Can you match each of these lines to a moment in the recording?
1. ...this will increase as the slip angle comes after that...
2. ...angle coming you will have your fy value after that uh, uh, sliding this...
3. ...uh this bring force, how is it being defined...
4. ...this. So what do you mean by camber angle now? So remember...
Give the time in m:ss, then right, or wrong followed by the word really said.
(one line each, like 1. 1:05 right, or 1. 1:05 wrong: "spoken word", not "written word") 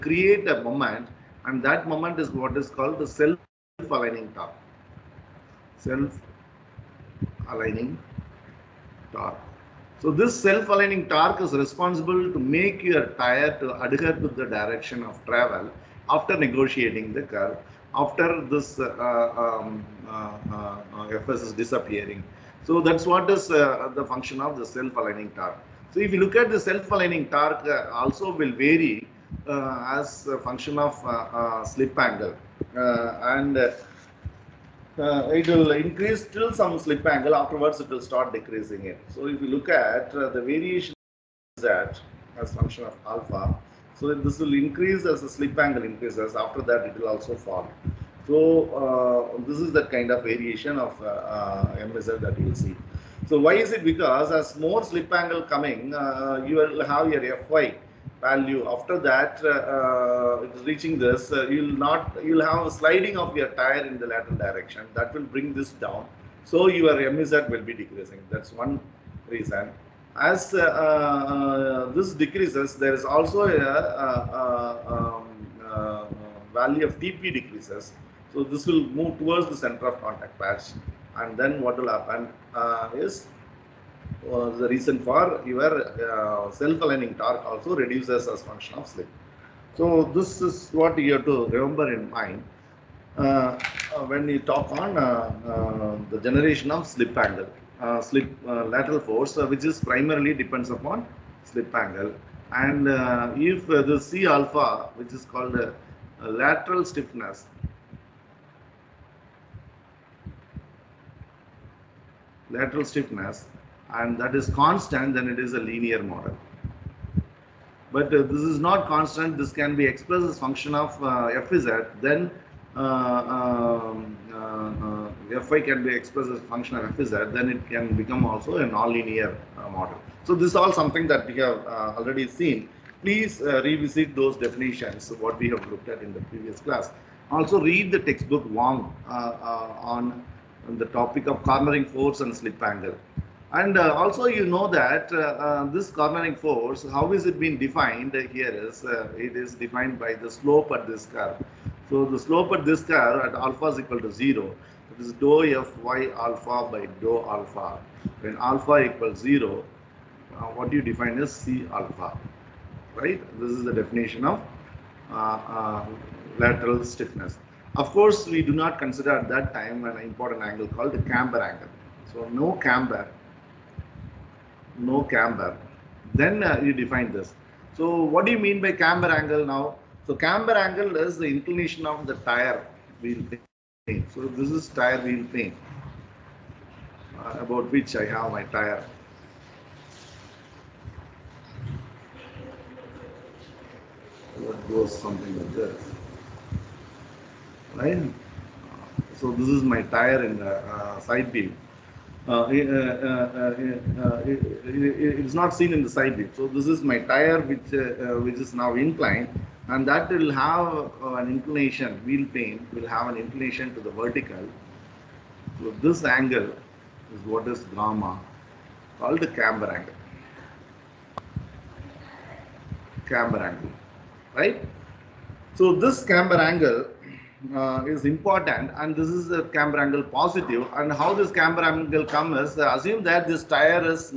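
1. 0:44 wrong: "increases", not "comes"
2. 0:55 wrong: "reaching", not "sliding"
3. 2:25 wrong: "cornering", not "bring"
4. 2:57 wrong: "camber", not "remember".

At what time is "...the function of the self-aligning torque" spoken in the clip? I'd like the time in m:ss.
0:23.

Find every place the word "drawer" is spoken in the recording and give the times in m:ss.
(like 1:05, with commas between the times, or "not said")
not said.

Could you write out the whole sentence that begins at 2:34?
It is dou f y alpha by dou alpha.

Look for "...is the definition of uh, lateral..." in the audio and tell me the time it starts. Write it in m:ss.
2:43.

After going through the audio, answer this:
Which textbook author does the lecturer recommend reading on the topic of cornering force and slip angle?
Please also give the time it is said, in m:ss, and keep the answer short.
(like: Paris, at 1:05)
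Wong, at 2:18.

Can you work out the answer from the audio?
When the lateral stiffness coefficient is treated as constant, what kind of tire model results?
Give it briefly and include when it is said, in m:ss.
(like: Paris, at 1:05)
linear model, at 1:55.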